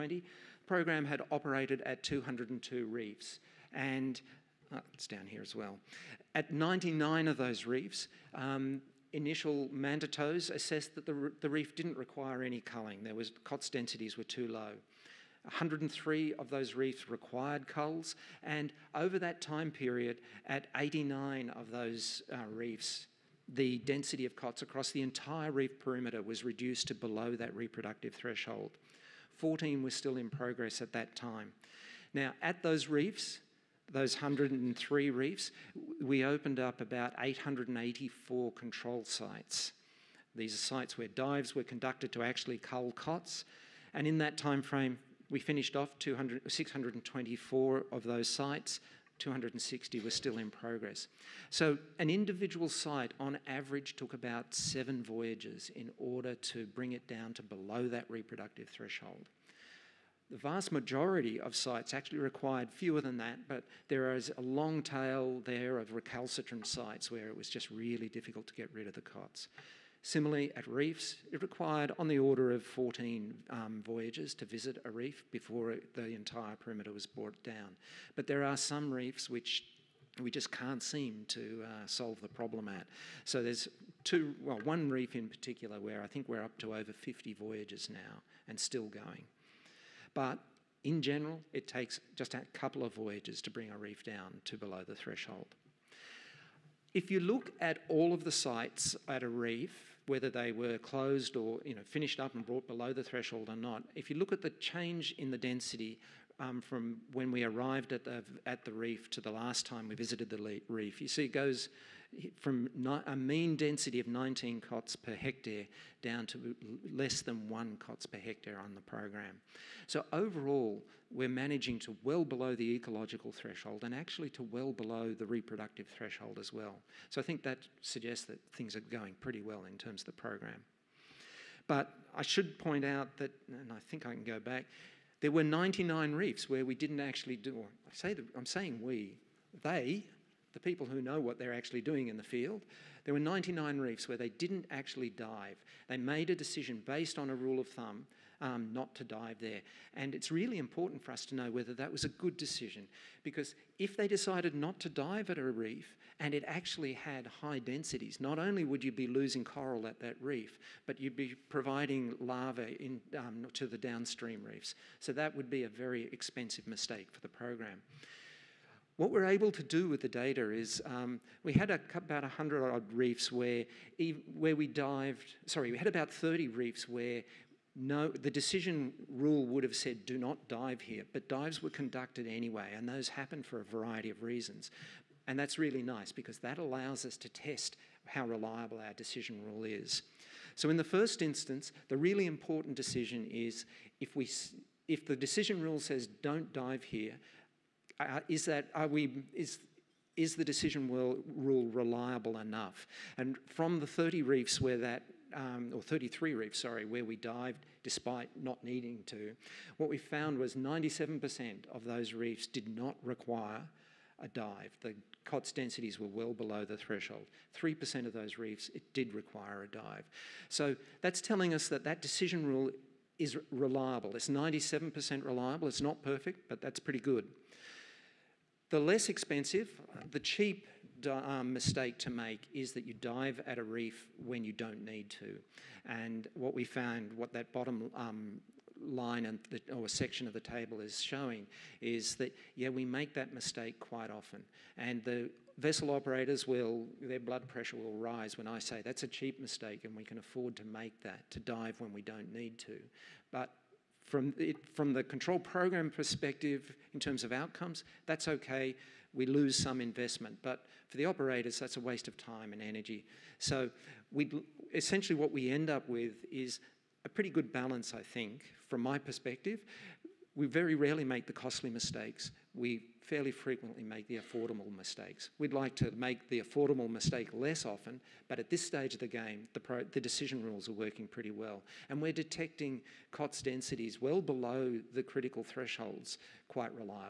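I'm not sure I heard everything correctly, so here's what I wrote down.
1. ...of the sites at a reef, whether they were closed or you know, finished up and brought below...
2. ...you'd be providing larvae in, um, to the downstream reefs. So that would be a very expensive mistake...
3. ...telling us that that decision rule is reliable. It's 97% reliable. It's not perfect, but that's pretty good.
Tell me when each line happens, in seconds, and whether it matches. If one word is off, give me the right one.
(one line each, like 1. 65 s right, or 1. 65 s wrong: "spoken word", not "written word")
1. 98 s right
2. 160 s right
3. 221 s right.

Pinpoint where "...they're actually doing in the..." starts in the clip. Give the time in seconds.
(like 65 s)
141 s.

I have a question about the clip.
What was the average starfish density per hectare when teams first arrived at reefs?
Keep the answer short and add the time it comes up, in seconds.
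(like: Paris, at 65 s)
19, at 114 s.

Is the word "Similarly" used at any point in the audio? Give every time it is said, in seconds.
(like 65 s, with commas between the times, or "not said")
70 s.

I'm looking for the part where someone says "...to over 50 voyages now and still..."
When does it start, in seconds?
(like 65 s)
86 s.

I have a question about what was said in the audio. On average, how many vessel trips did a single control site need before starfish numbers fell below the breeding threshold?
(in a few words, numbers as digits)
7.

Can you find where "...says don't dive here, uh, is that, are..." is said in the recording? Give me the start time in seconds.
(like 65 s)
195 s.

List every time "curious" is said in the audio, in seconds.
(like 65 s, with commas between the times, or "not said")
not said.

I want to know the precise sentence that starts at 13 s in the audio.
There was COTS densities were too low.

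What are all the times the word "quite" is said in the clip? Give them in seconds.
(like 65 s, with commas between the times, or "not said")
243 s, 286 s.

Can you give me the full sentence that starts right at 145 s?
They made a decision based on a rule of thumb um, not to dive there.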